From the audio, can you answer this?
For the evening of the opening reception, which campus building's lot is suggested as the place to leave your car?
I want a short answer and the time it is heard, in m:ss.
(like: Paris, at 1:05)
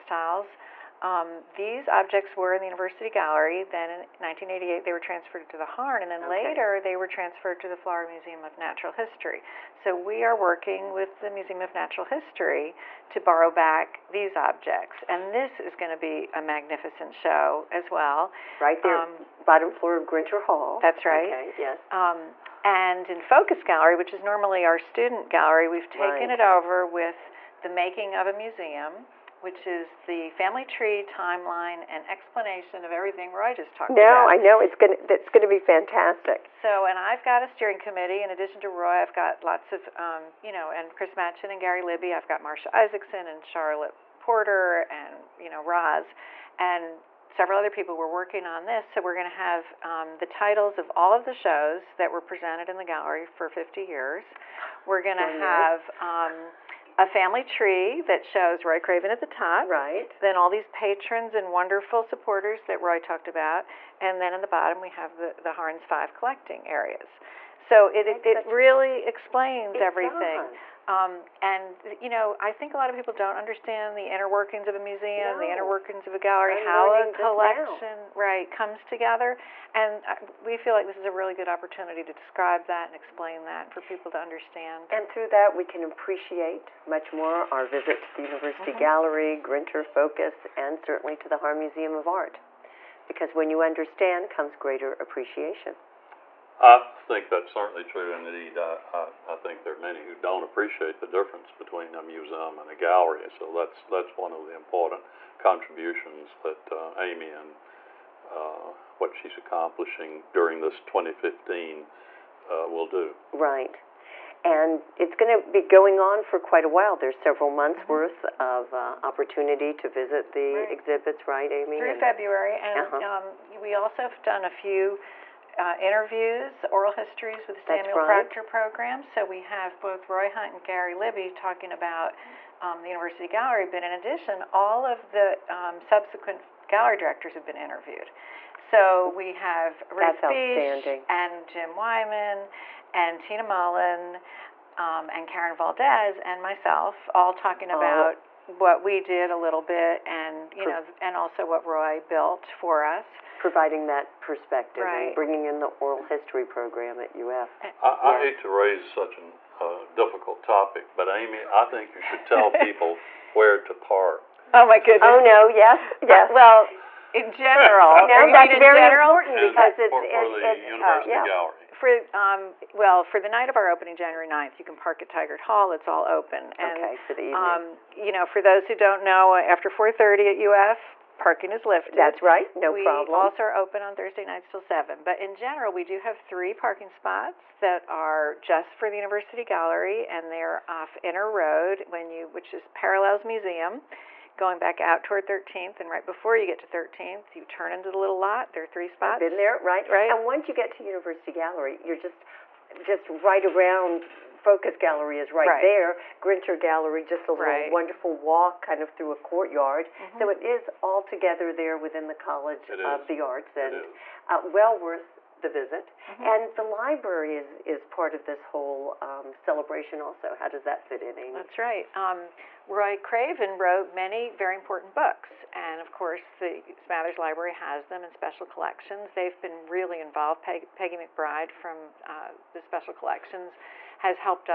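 Tigert Hall, at 2:55.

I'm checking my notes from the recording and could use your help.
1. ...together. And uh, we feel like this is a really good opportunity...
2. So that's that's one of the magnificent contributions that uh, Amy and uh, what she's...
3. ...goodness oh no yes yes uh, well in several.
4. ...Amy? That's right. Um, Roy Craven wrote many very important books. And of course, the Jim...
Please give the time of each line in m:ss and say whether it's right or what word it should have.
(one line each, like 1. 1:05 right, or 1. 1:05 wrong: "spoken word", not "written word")
1. 1:18 right
2. 1:43 wrong: "important", not "magnificent"
3. 2:44 wrong: "general", not "several"
4. 3:41 wrong: "Smathers", not "Jim".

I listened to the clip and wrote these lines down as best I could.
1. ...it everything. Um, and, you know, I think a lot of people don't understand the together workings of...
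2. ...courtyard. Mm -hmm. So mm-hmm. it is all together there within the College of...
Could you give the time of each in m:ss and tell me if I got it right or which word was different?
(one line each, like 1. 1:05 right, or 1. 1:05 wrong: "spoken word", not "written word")
1. 1:09 wrong: "inner", not "together"
2. 3:29 right.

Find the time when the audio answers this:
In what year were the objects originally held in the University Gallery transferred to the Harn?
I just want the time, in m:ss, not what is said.
0:04.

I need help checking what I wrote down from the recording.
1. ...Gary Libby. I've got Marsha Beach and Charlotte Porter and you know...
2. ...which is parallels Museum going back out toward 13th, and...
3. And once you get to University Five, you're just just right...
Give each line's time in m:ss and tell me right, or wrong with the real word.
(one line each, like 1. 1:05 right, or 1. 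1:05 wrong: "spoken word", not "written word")
1. 0:41 wrong: "Isaacson", not "Beach"
2. 3:12 right
3. 3:20 wrong: "Gallery", not "Five".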